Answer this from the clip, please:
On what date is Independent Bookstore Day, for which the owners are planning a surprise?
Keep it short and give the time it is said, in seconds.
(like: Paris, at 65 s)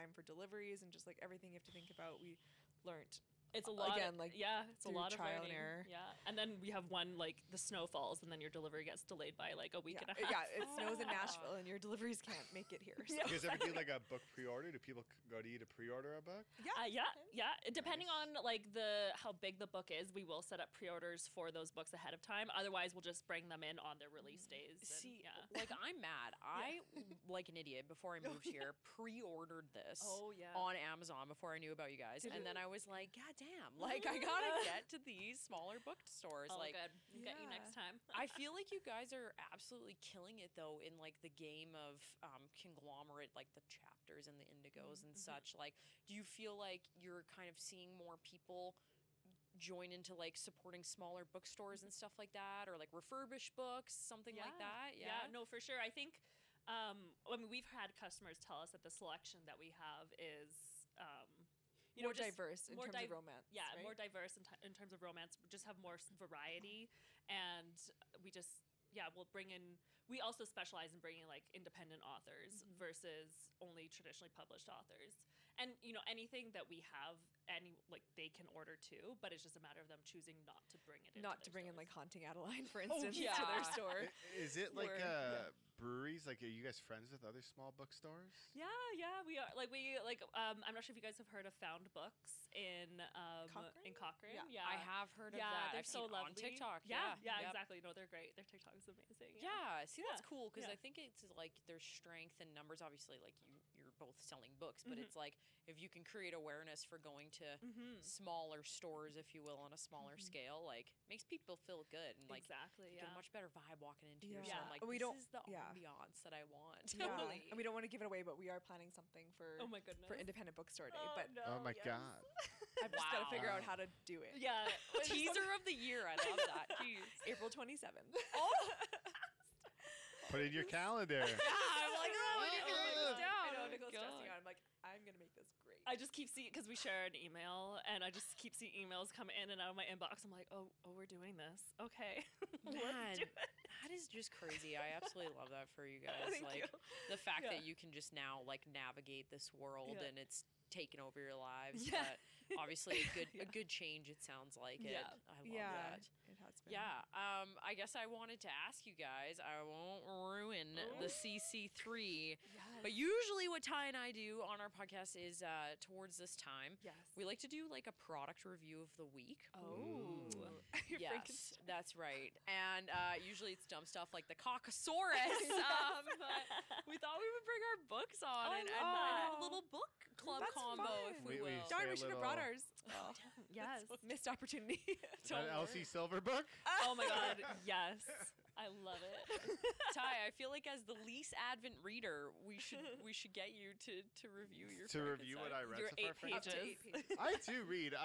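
April 27th, at 127 s.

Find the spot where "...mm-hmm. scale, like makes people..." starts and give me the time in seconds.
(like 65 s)
110 s.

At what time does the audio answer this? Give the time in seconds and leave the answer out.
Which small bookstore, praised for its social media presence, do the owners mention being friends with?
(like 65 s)
91 s.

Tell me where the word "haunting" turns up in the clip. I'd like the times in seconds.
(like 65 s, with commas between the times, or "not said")
81 s.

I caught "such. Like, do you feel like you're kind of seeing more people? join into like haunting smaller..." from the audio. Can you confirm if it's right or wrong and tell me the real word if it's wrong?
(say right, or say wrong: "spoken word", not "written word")
wrong: "supporting", not "haunting".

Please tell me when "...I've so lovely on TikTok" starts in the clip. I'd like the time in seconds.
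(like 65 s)
95 s.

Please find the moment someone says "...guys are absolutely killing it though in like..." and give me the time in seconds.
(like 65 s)
38 s.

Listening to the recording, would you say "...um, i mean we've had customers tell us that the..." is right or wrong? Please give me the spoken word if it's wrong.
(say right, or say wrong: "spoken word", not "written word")
right.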